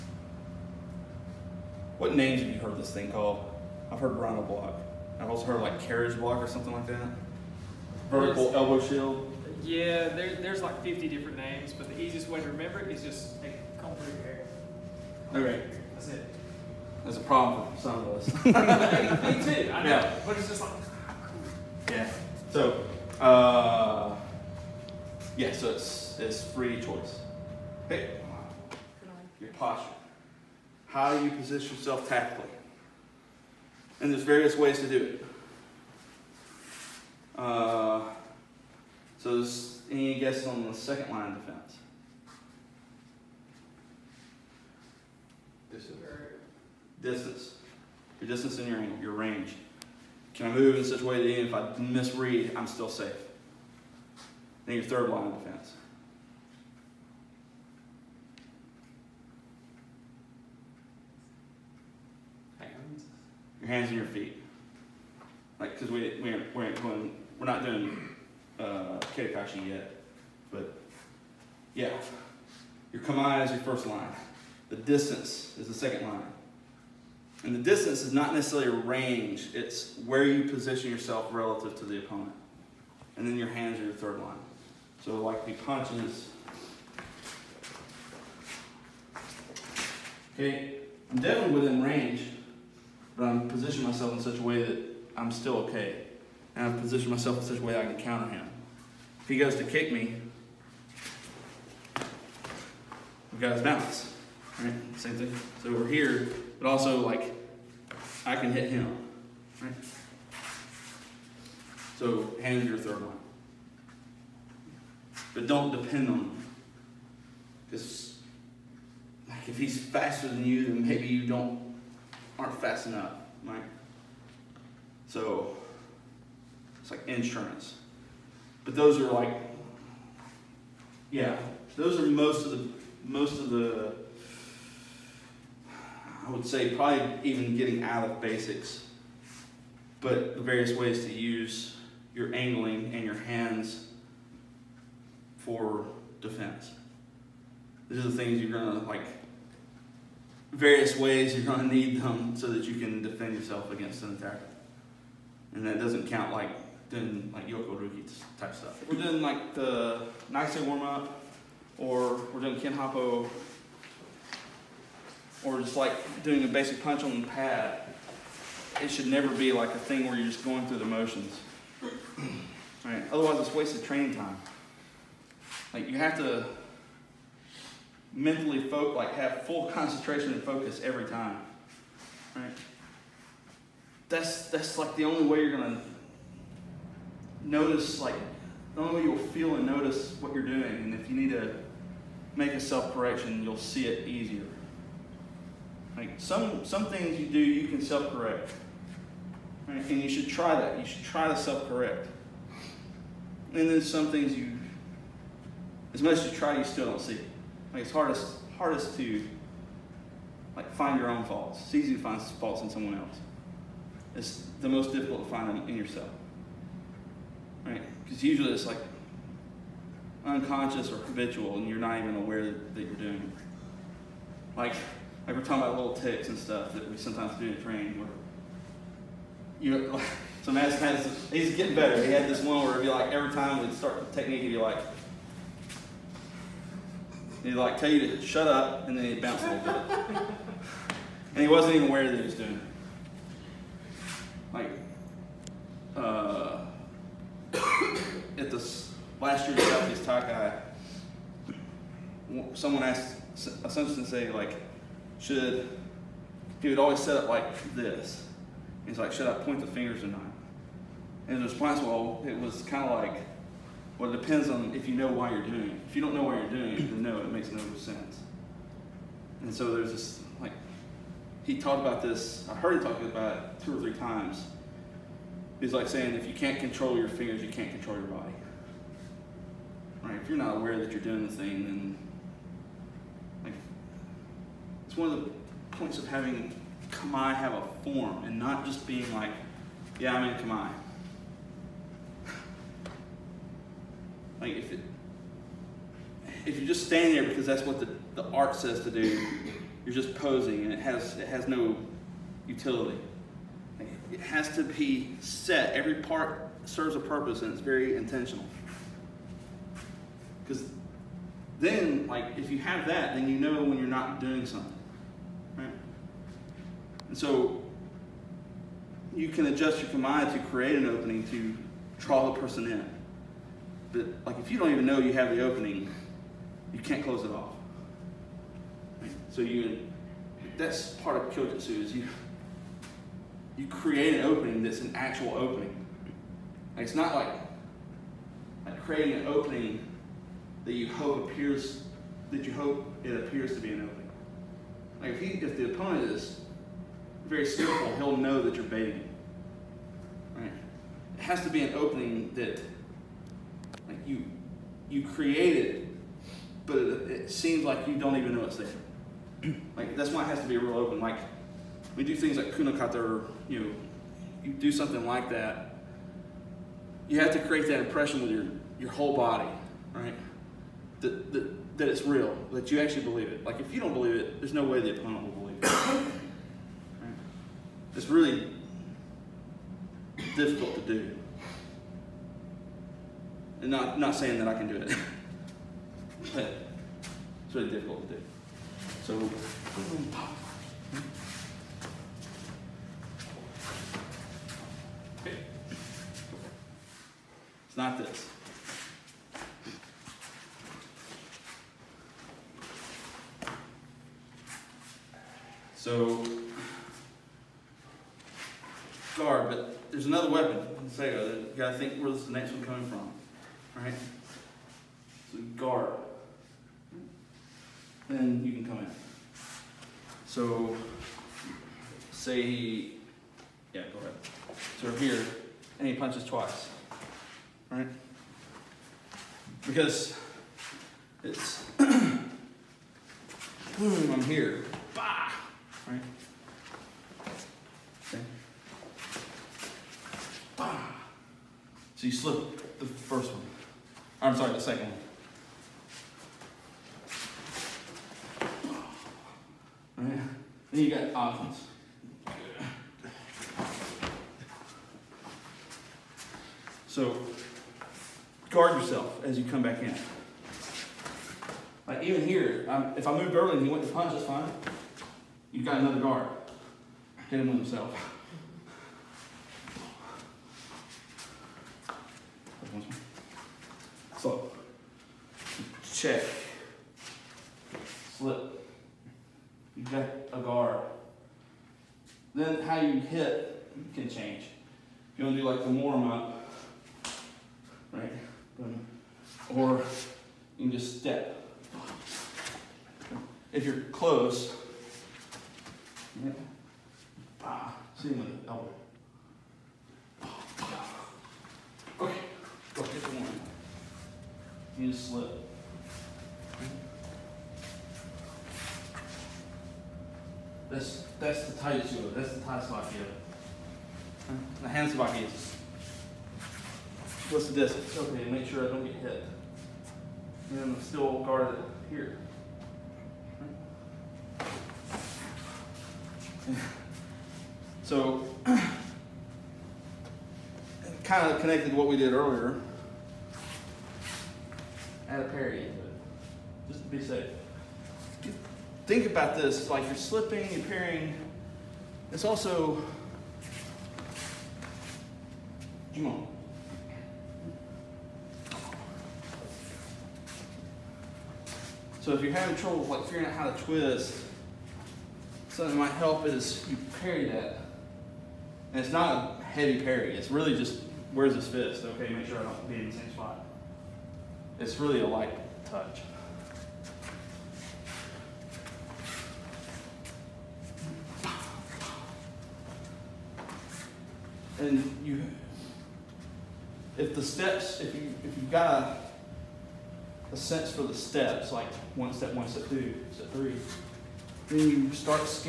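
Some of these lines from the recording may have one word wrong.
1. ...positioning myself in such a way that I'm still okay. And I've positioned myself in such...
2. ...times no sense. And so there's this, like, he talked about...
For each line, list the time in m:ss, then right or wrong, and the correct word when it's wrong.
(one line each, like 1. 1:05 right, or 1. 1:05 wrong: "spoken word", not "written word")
1. 1:33 right
2. 4:27 wrong: "makes", not "times".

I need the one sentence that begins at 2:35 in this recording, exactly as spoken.
And that doesn't count like doing like Yoko Ruki type stuff.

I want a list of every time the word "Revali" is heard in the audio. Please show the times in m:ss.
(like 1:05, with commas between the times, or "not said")
not said.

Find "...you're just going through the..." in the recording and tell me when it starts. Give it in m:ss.
2:50.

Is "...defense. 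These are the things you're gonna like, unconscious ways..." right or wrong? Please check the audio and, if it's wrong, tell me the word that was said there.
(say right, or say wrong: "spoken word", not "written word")
wrong: "various", not "unconscious".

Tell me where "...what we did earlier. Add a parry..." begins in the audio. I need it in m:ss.
8:51.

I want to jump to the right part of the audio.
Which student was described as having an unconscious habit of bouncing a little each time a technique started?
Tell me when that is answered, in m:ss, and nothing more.
3:50.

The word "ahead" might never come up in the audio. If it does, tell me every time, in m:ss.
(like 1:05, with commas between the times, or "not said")
7:03.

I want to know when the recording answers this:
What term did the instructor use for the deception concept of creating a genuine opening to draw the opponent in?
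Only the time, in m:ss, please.
5:31.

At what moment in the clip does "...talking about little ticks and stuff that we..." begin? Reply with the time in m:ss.
3:45.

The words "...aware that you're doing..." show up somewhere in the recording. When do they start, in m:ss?
4:40.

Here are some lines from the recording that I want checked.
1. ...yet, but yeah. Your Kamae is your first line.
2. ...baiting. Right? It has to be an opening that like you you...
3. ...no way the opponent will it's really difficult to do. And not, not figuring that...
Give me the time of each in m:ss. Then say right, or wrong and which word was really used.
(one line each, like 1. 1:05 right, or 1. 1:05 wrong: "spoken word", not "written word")
1. 1:09 right
2. 5:48 right
3. 6:14 wrong: "saying", not "figuring".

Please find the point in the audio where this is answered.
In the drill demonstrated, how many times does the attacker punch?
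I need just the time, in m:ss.
7:06.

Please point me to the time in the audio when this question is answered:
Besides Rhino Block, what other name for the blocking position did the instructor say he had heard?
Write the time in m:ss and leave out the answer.
0:05.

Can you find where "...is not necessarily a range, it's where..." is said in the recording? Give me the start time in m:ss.
1:18.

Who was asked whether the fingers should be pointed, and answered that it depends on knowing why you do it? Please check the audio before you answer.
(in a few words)
Hatsumi Sensei.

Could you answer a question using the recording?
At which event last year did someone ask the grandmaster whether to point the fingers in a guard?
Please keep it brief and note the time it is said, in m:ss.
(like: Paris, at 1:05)
Southeast, at 4:09.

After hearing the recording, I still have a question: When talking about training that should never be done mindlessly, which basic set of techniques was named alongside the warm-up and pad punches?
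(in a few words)
Kihon Happo.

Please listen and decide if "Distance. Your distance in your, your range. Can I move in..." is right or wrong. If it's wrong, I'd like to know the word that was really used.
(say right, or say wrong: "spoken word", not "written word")
right.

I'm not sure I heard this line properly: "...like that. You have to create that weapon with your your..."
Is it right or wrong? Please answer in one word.
wrong.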